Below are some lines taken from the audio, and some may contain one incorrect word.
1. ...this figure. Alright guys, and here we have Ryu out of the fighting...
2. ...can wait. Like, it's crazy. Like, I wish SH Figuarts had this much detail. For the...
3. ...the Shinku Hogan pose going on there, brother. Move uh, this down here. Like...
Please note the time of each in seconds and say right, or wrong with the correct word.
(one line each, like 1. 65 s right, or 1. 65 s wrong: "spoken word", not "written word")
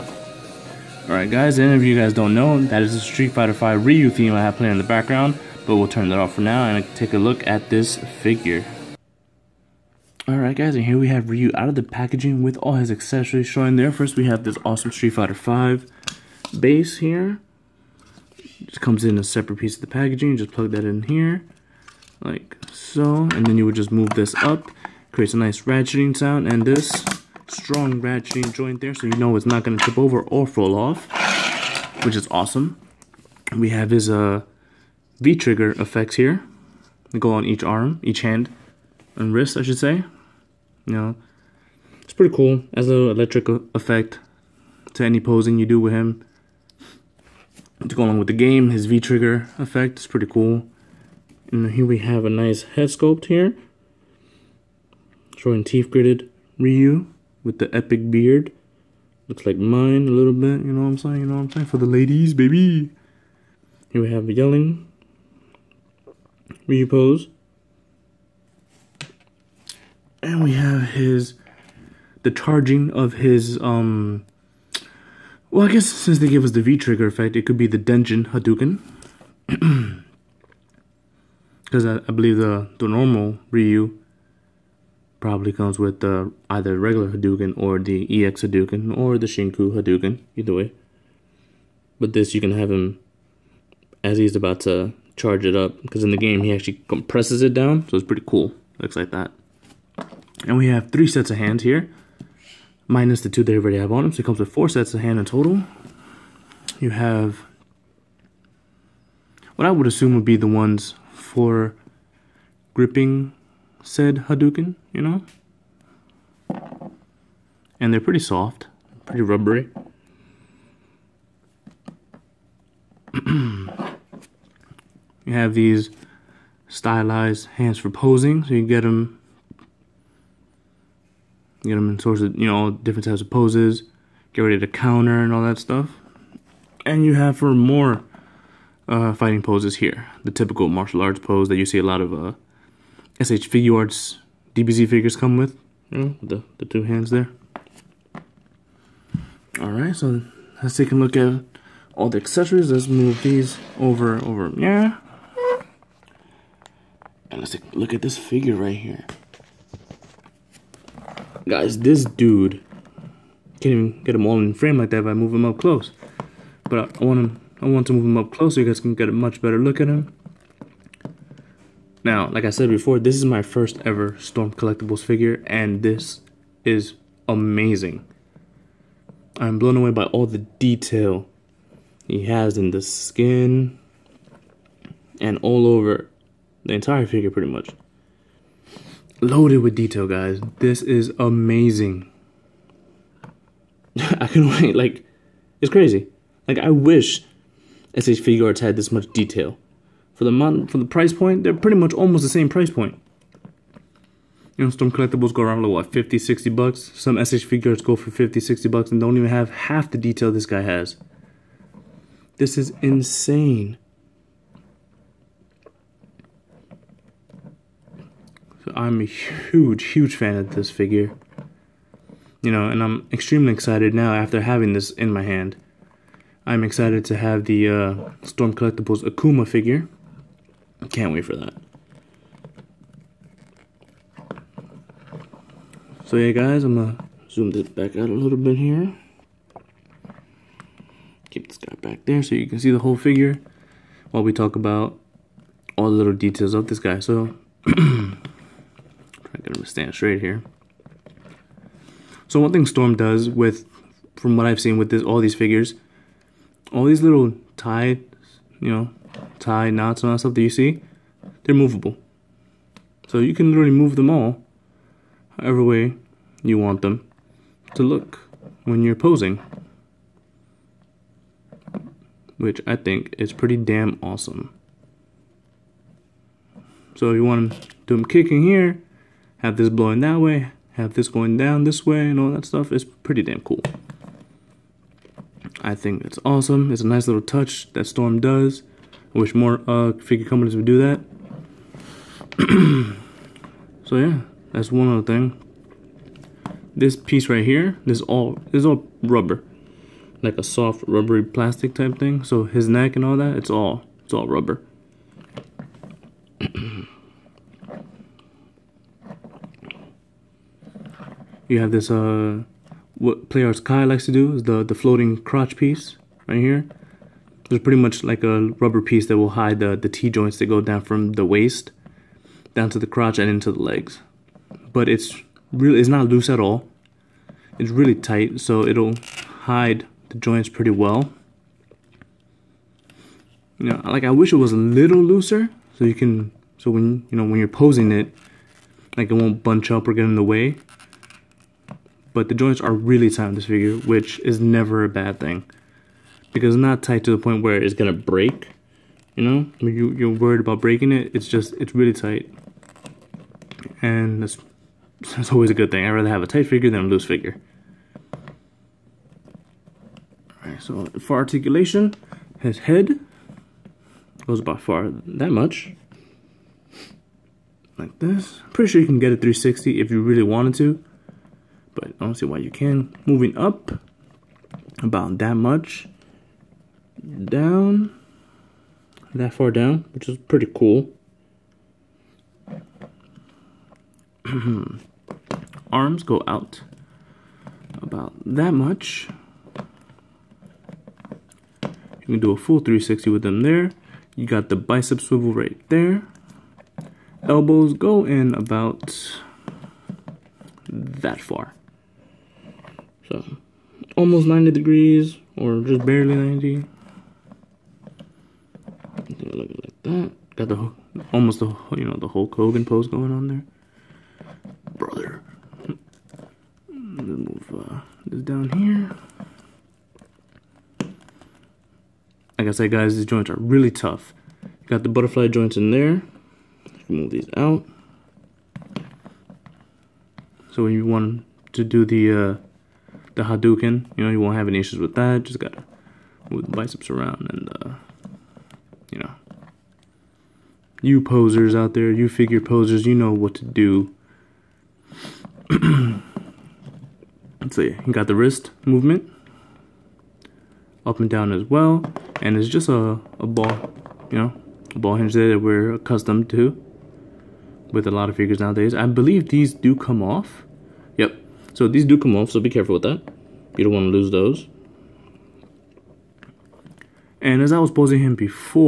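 1. 7 s wrong: "packaging", not "fighting"
2. 194 s right
3. 411 s wrong: "Hulk", not "Shinku".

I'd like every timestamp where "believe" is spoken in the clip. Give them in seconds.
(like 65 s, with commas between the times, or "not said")
82 s, 458 s.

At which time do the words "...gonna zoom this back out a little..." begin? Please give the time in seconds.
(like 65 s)
236 s.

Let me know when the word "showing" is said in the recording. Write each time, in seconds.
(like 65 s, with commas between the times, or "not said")
13 s, 55 s.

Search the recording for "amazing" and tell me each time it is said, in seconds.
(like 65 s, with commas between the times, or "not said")
177 s, 191 s.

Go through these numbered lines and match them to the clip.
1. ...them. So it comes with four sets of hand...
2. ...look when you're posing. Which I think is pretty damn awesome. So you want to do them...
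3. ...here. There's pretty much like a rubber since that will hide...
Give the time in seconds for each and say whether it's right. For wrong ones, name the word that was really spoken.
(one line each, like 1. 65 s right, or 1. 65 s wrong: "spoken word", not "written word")
1. 104 s right
2. 267 s right
3. 316 s wrong: "piece", not "since".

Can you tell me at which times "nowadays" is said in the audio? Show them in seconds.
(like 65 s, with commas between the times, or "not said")
458 s.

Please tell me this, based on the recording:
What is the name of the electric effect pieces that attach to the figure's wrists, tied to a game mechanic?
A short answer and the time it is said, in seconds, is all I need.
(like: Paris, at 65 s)
V-trigger effects, at 35 s.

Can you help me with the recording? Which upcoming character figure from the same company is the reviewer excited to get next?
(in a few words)
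Akuma.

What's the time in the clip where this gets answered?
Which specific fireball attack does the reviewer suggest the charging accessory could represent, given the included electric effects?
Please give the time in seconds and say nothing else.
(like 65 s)
77 s.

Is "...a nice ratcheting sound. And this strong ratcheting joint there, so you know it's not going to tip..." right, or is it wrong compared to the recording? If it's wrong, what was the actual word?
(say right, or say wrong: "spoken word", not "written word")
right.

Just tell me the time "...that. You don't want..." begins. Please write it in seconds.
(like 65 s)
462 s.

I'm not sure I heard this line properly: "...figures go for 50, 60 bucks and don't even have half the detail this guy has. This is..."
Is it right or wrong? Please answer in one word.
right.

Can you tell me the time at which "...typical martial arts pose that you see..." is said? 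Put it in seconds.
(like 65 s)
140 s.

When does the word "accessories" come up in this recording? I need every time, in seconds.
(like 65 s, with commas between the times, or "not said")
12 s, 152 s.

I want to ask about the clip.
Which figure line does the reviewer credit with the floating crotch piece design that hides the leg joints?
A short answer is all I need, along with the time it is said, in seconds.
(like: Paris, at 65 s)
Play Arts Kai, at 313 s.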